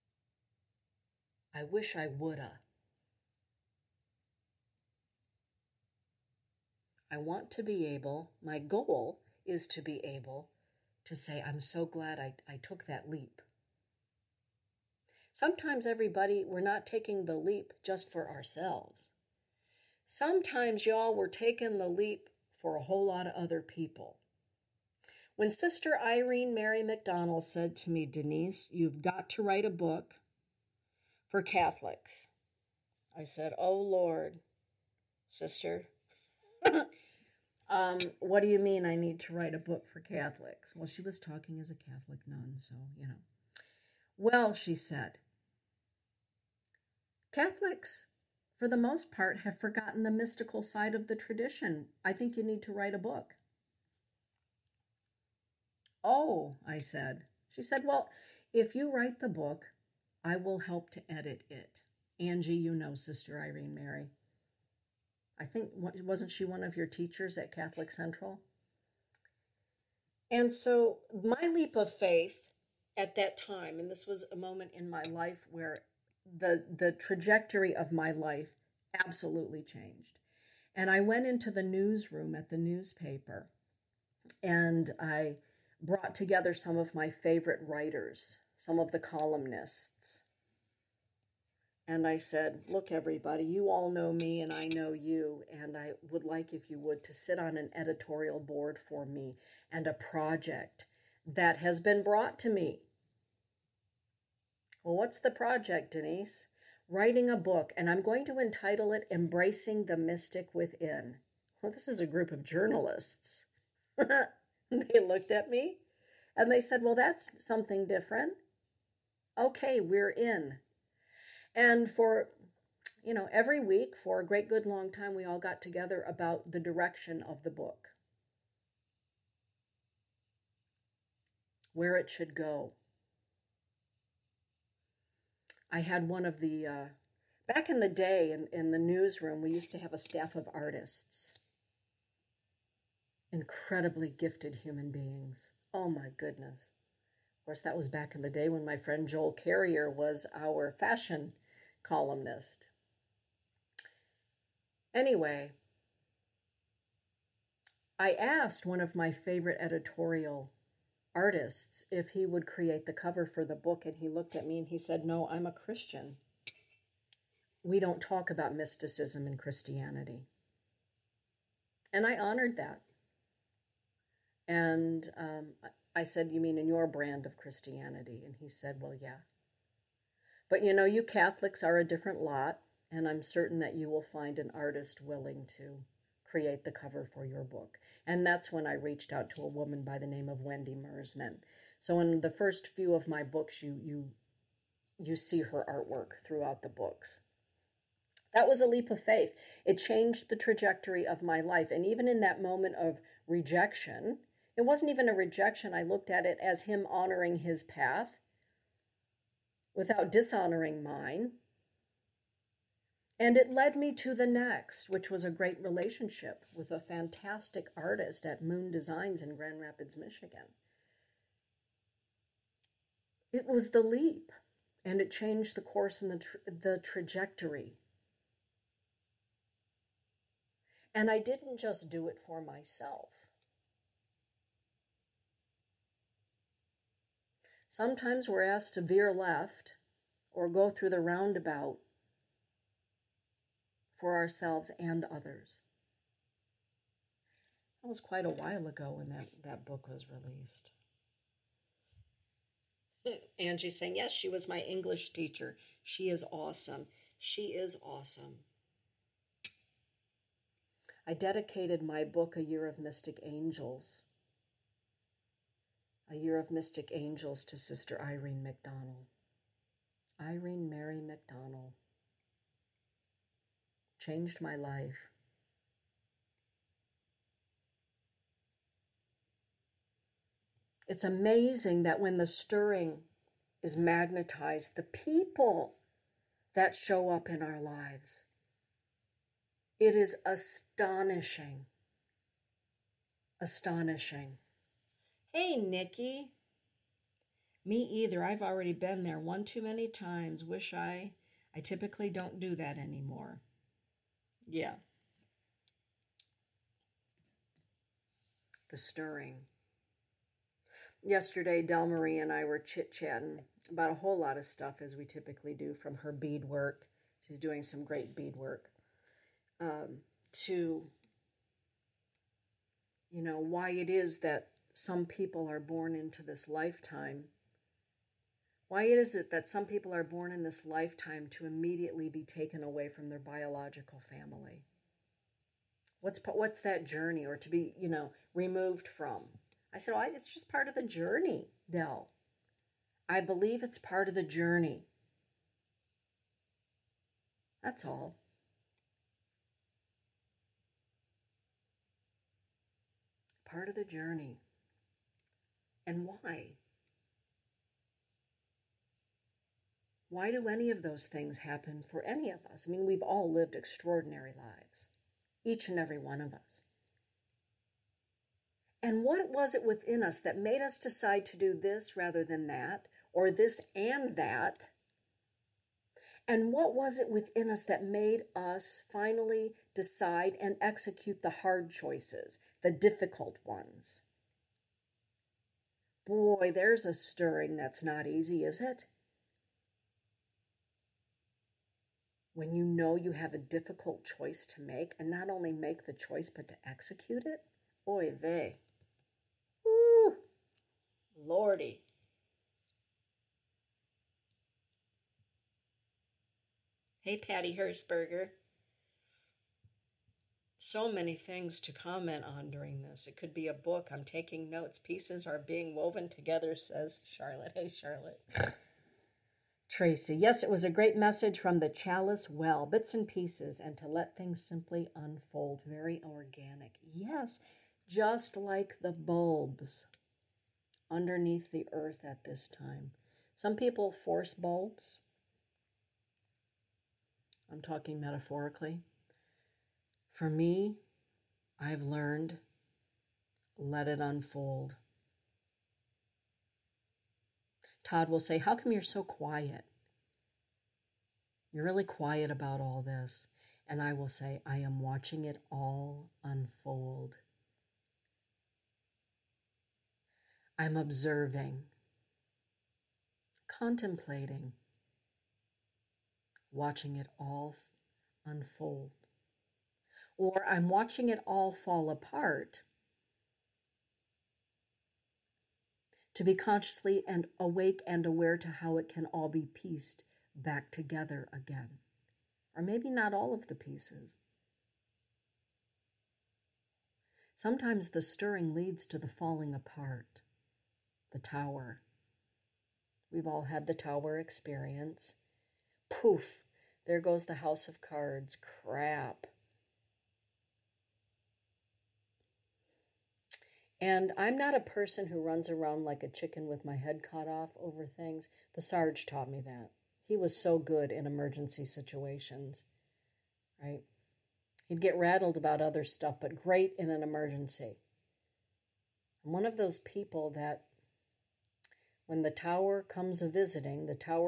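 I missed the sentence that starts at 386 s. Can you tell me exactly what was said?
Boy, there's a stirring that's not easy, is it?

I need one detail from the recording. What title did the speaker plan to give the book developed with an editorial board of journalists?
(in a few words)
Embracing the Mystic Within.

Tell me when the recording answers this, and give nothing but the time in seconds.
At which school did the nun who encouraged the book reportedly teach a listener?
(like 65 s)
67 s.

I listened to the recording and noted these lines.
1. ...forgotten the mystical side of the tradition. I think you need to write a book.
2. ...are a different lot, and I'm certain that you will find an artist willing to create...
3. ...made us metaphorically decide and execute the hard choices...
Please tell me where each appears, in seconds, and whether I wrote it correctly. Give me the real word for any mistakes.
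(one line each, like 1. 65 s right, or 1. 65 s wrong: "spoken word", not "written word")
1. 49 s right
2. 181 s right
3. 377 s wrong: "finally", not "metaphorically".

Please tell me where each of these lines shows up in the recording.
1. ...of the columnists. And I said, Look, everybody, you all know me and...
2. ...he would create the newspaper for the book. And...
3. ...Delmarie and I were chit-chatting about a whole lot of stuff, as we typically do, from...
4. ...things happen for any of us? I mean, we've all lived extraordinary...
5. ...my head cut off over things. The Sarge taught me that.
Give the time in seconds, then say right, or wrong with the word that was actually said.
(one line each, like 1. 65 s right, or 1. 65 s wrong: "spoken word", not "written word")
1. 88 s right
2. 162 s wrong: "cover", not "newspaper"
3. 311 s right
4. 361 s right
5. 506 s right.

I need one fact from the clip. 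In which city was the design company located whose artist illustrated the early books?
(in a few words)
Grand Rapids.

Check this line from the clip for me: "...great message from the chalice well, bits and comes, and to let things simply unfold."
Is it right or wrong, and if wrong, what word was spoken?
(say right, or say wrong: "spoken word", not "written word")
wrong: "pieces", not "comes".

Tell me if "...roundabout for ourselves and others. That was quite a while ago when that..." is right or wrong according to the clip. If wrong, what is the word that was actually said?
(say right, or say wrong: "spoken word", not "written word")
right.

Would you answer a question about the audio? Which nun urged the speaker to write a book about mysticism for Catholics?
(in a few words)
Sister Irene Mary McDonald.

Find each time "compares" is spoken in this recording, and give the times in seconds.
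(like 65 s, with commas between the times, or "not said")
not said.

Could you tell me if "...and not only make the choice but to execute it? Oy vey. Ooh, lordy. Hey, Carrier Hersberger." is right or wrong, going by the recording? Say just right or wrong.
wrong.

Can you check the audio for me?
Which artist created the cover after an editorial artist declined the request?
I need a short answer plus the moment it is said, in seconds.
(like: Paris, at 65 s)
Wendy Mersman, at 190 s.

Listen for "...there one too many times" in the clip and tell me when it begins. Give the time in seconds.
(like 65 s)
299 s.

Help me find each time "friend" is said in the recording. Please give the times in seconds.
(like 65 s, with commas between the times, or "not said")
148 s.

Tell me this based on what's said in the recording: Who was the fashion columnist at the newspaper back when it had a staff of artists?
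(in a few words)
Joel Carrier.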